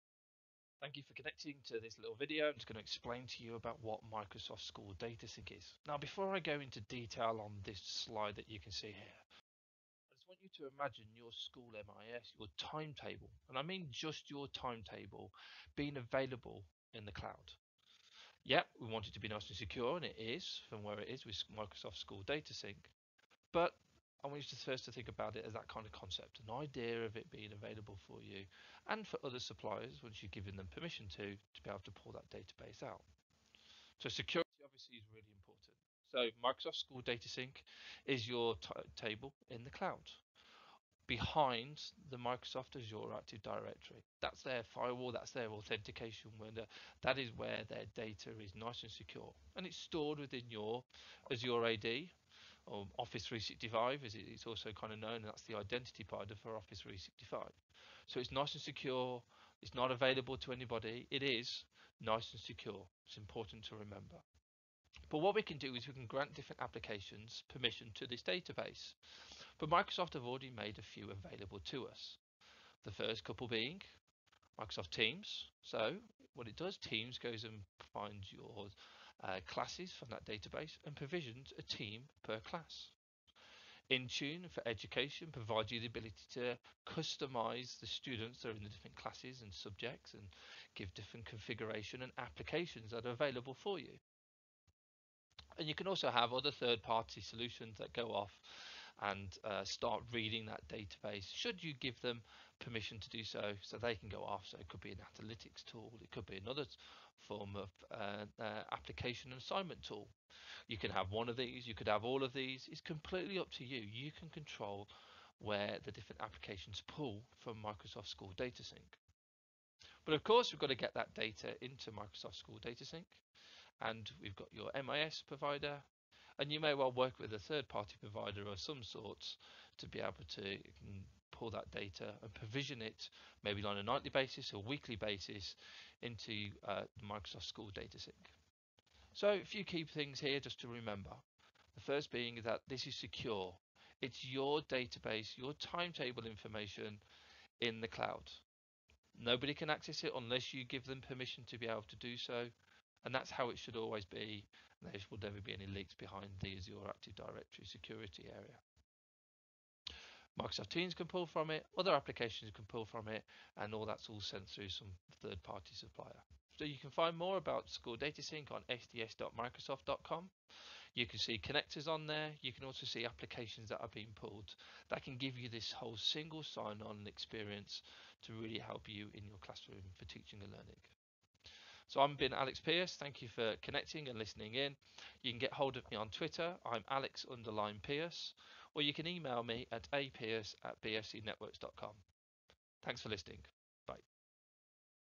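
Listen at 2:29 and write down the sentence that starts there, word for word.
Nobody can access it unless you give them permission to be able to do so.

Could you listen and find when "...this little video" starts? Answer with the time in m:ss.
0:01.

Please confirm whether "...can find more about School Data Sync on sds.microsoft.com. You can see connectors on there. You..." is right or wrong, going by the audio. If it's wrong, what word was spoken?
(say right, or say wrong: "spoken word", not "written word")
right.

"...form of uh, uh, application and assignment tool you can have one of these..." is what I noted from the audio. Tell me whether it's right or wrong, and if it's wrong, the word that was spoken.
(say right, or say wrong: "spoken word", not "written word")
right.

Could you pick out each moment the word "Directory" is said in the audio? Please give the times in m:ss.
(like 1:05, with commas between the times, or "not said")
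0:43, 2:37.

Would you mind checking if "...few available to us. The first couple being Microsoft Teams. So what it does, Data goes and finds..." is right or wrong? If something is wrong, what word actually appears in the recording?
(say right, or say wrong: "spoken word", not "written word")
wrong: "Teams", not "Data".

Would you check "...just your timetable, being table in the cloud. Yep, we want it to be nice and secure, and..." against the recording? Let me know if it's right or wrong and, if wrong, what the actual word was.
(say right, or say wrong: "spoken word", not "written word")
wrong: "available", not "table".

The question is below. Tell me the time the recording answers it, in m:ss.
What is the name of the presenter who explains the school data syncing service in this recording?
3:02.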